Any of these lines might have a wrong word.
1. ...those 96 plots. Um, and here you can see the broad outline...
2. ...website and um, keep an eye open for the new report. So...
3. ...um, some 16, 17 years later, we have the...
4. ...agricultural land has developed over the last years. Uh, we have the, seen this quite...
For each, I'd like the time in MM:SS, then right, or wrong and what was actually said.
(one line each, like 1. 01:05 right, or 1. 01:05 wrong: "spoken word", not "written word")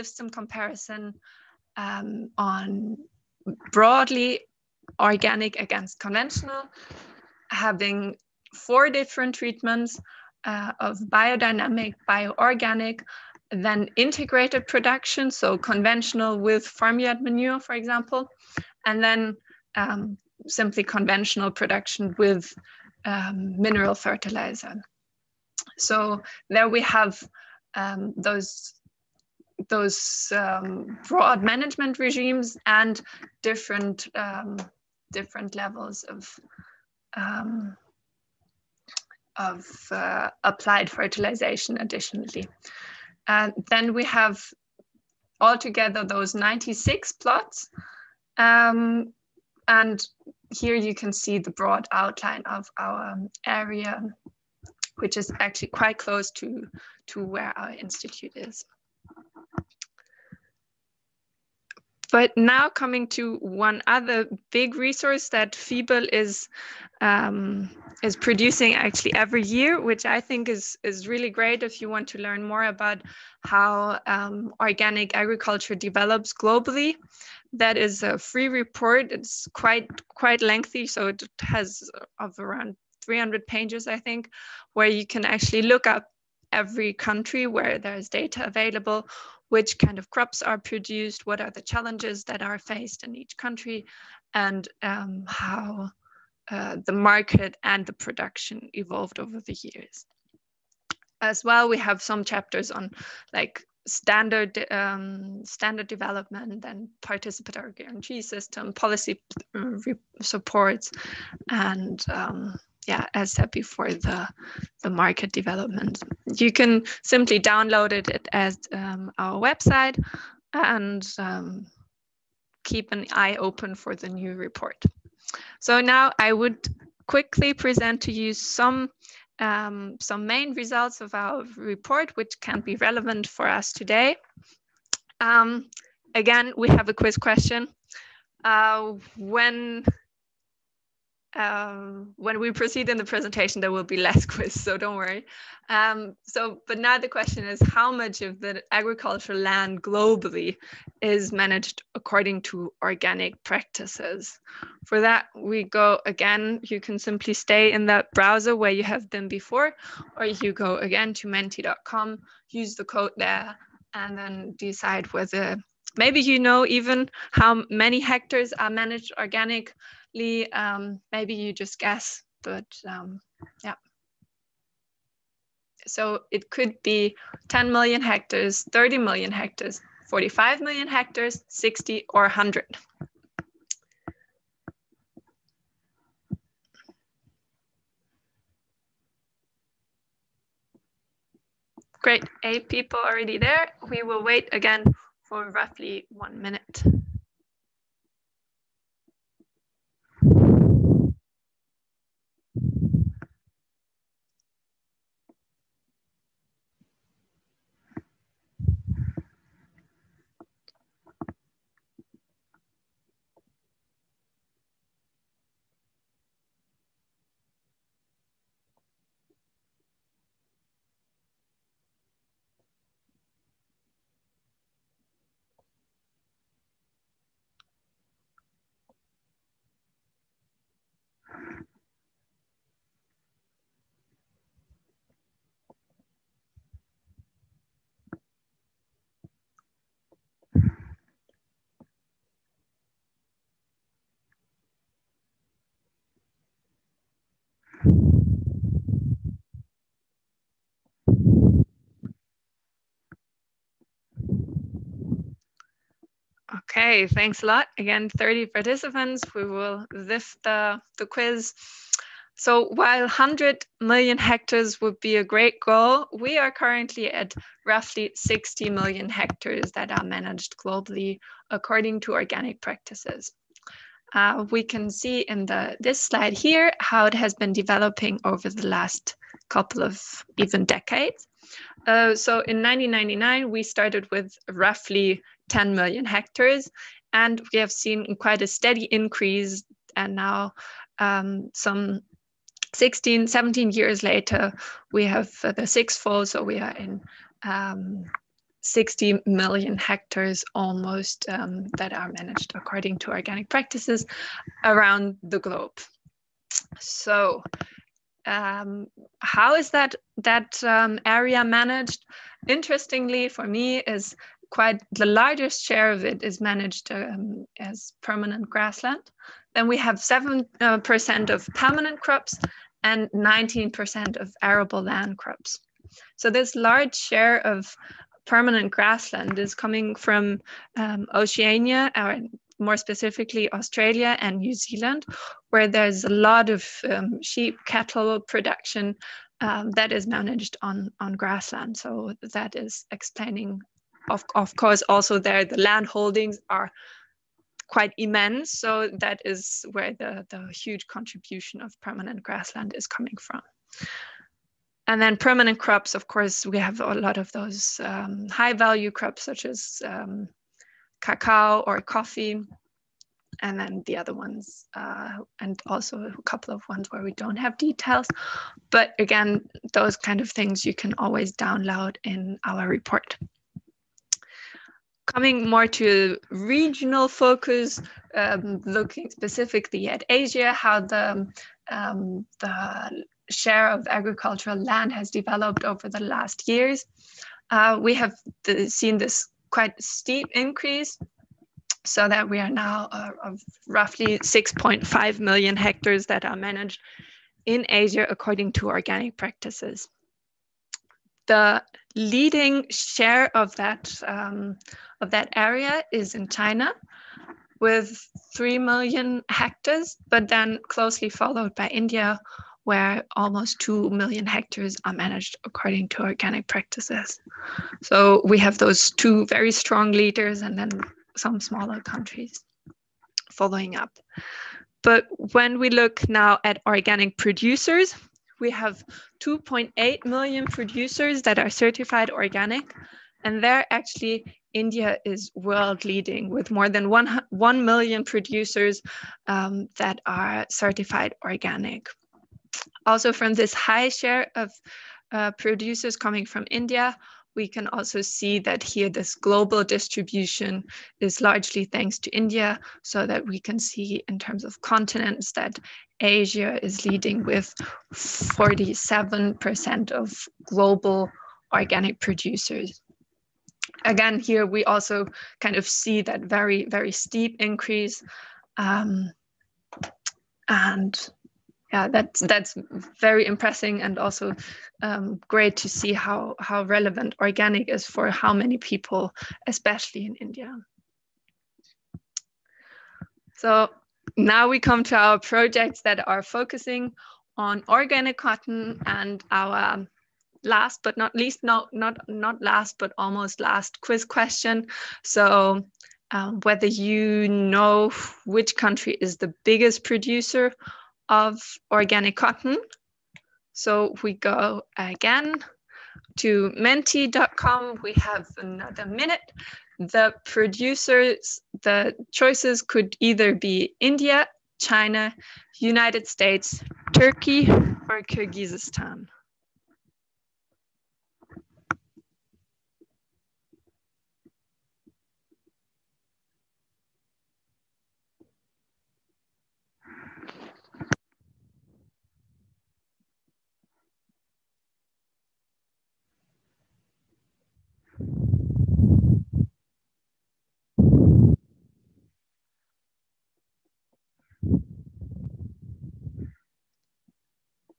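1. 00:46 right
2. 01:59 right
3. 04:50 right
4. 06:23 right.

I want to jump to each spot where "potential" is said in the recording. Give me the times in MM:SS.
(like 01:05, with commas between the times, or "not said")
not said.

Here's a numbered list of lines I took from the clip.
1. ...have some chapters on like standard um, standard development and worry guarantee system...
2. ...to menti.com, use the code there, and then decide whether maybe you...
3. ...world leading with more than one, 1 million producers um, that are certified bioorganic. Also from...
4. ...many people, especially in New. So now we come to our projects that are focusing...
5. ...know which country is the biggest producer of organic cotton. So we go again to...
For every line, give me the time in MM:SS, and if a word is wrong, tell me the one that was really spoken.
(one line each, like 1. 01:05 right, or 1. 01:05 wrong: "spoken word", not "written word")
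1. 01:41 wrong: "participatory", not "worry"
2. 02:41 right
3. 07:15 wrong: "organic", not "bioorganic"
4. 07:58 wrong: "India", not "New"
5. 08:17 right.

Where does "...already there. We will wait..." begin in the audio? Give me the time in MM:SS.
03:12.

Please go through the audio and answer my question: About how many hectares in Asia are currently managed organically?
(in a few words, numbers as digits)
6.5 million hectares.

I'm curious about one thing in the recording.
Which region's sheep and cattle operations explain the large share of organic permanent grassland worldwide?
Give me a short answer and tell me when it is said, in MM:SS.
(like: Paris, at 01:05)
Oceania, at 05:31.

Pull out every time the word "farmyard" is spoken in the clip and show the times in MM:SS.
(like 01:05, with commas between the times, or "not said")
00:16.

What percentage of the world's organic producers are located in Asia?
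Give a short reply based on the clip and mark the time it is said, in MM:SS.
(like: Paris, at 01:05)
47%, at 07:37.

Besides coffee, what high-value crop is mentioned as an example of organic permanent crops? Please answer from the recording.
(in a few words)
Cacao.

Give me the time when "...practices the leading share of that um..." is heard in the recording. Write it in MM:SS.
06:39.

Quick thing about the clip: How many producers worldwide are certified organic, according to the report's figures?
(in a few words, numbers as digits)
2.8 million.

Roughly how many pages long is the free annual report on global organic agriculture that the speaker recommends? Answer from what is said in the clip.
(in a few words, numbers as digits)
300.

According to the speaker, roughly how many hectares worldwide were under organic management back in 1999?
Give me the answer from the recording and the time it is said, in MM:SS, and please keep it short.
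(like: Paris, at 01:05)
10 million hectares, at 04:44.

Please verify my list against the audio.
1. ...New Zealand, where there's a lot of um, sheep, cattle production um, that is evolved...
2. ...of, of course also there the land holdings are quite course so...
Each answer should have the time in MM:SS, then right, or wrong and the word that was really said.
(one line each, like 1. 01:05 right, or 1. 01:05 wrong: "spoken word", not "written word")
1. 05:34 wrong: "managed", not "evolved"
2. 05:44 wrong: "immense", not "course".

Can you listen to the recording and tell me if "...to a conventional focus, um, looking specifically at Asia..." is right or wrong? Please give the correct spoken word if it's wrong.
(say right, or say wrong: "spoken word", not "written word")
wrong: "regional", not "conventional".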